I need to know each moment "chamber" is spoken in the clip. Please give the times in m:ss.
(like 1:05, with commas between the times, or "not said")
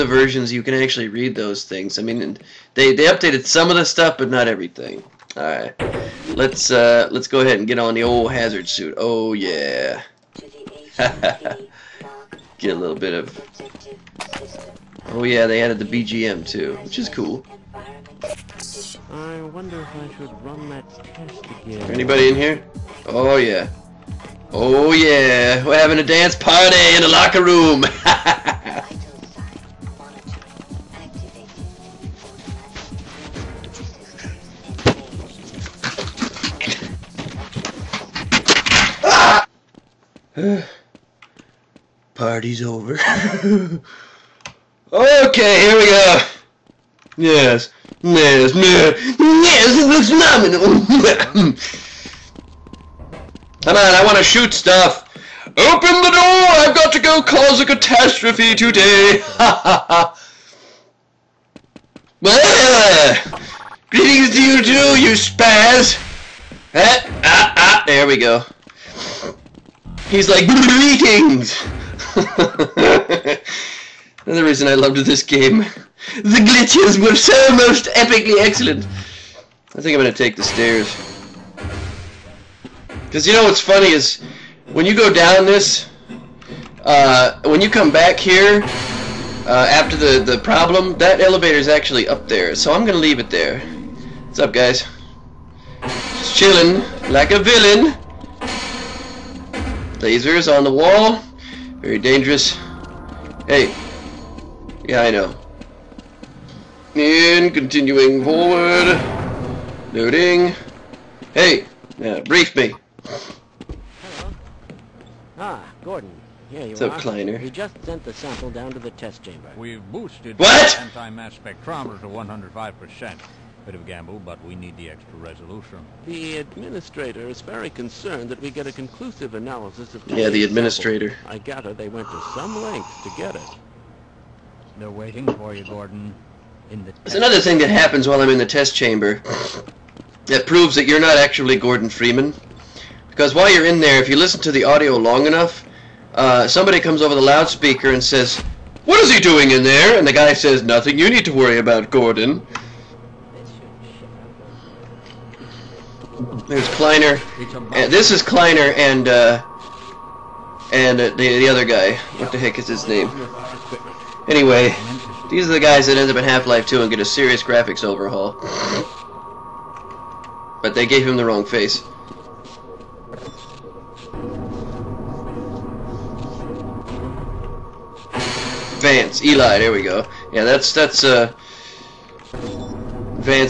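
1:59, 2:18.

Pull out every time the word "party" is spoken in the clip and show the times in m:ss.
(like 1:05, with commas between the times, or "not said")
0:26, 0:42.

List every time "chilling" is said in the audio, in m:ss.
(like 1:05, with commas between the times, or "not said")
1:36.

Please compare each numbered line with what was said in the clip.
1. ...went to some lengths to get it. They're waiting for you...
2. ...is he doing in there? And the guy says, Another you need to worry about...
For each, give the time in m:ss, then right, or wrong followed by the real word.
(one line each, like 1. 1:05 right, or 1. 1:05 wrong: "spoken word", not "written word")
1. 2:11 right
2. 2:29 wrong: "Nothing", not "Another".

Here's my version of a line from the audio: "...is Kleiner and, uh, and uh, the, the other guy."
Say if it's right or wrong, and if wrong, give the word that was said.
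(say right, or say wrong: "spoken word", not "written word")
right.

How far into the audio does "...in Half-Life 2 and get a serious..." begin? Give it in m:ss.
2:46.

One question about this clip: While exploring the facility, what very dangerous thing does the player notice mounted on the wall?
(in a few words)
Lasers.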